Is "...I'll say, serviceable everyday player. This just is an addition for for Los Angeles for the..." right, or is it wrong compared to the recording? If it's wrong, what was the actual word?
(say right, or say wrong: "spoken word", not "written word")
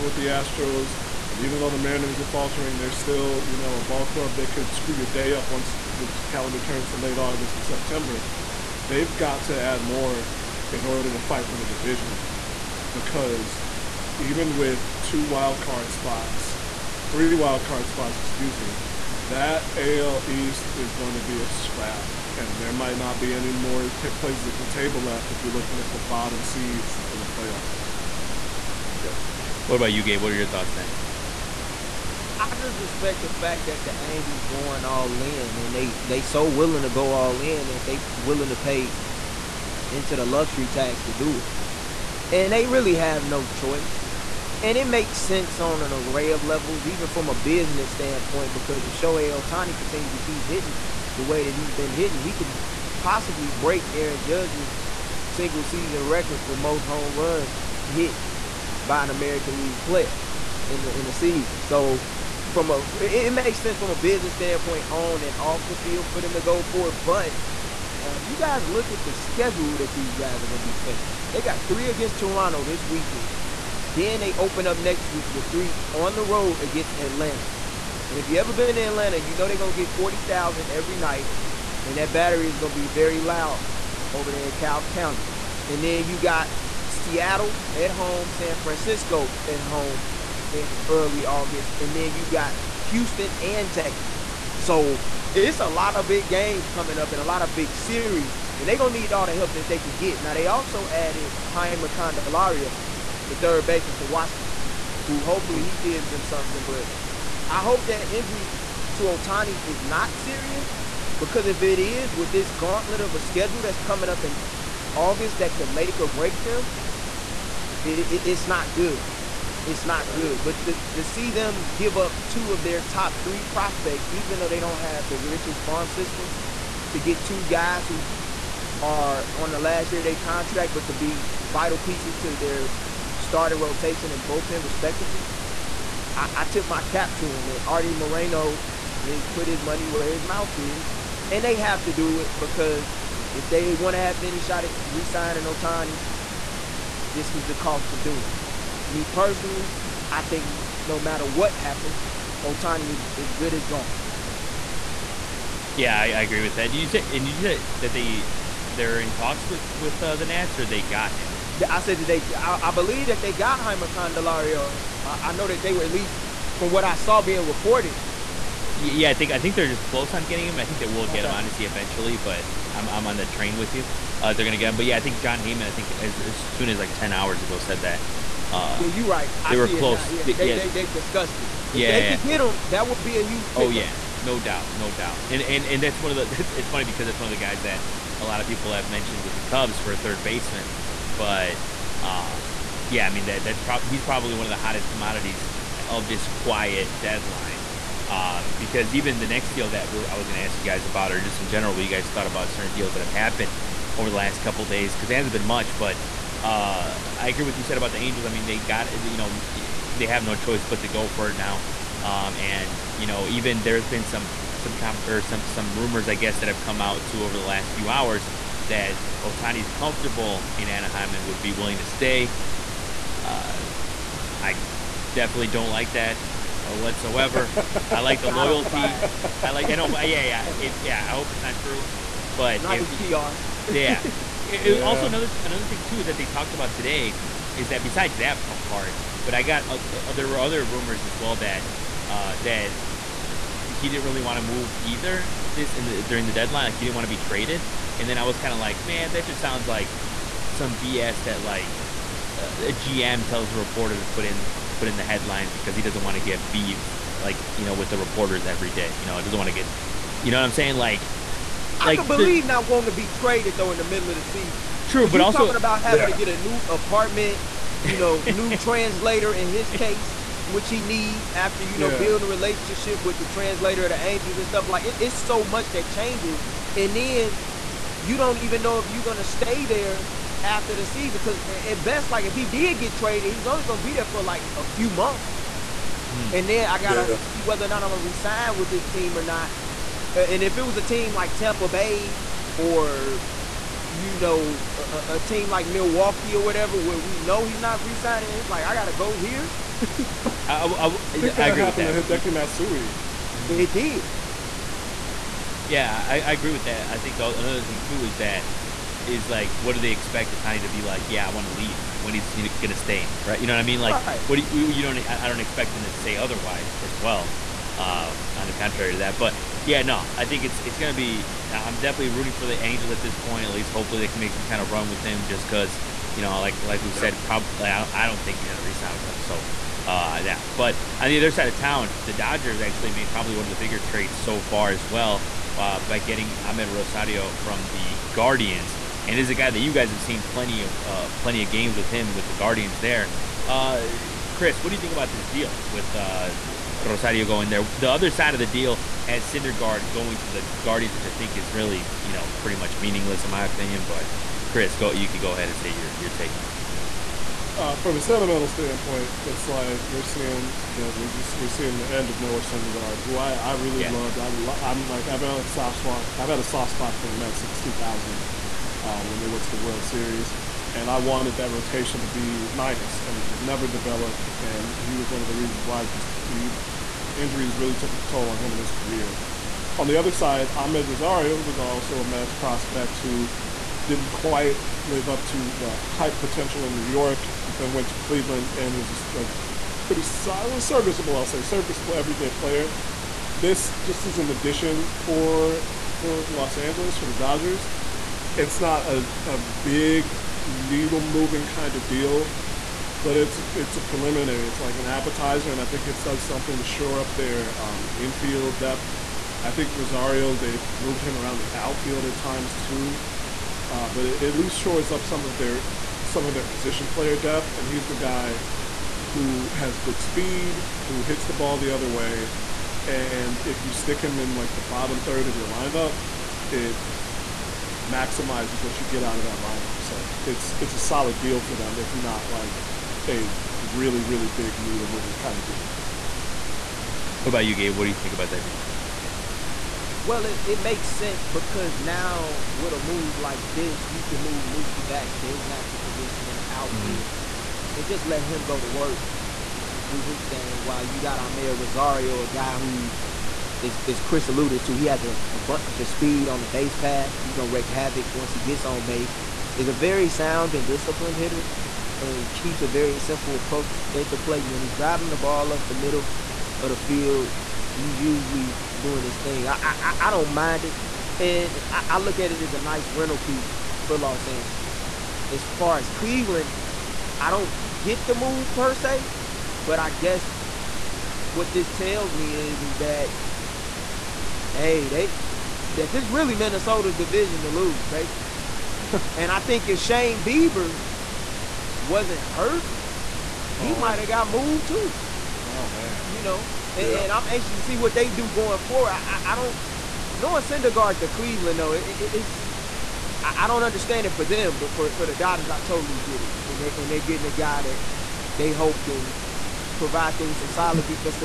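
right.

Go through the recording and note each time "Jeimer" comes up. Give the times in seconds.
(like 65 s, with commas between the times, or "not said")
101 s.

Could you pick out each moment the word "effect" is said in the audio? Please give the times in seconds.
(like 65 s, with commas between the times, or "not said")
not said.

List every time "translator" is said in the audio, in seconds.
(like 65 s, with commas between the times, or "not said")
268 s, 273 s.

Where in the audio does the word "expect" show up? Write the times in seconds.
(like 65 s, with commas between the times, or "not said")
309 s, 315 s.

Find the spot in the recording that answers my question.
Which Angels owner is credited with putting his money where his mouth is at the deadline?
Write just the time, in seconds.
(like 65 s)
137 s.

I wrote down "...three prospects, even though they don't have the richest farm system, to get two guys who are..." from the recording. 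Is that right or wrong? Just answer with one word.
right.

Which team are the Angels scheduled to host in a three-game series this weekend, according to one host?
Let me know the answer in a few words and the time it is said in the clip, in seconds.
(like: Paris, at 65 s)
Toronto, at 72 s.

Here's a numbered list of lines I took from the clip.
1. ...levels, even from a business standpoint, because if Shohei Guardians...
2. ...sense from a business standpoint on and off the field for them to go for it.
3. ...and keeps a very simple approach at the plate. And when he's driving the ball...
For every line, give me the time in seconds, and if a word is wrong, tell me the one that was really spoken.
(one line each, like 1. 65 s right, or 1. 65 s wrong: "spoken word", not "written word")
1. 46 s wrong: "Ohtani", not "Guardians"
2. 63 s right
3. 462 s right.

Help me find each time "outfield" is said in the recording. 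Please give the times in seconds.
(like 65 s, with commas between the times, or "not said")
411 s, 446 s.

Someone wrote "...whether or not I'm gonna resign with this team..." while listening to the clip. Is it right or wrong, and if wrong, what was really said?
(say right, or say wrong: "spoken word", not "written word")
right.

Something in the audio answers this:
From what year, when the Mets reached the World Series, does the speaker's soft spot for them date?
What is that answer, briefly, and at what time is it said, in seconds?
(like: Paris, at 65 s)
2000, at 367 s.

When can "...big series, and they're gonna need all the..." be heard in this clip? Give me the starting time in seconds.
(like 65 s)
97 s.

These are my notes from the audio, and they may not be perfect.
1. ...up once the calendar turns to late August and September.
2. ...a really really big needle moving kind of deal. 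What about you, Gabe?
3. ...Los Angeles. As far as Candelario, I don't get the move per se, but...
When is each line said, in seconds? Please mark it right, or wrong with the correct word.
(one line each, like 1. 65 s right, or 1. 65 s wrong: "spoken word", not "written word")
1. 5 s right
2. 433 s right
3. 473 s wrong: "Cleveland", not "Candelario".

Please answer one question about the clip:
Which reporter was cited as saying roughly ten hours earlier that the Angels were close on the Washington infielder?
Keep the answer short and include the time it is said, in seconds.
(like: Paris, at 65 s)
Jon Heyman, at 175 s.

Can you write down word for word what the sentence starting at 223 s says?
Uh, I definitely don't like that uh, whatsoever.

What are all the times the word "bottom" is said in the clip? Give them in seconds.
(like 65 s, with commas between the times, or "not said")
26 s, 424 s.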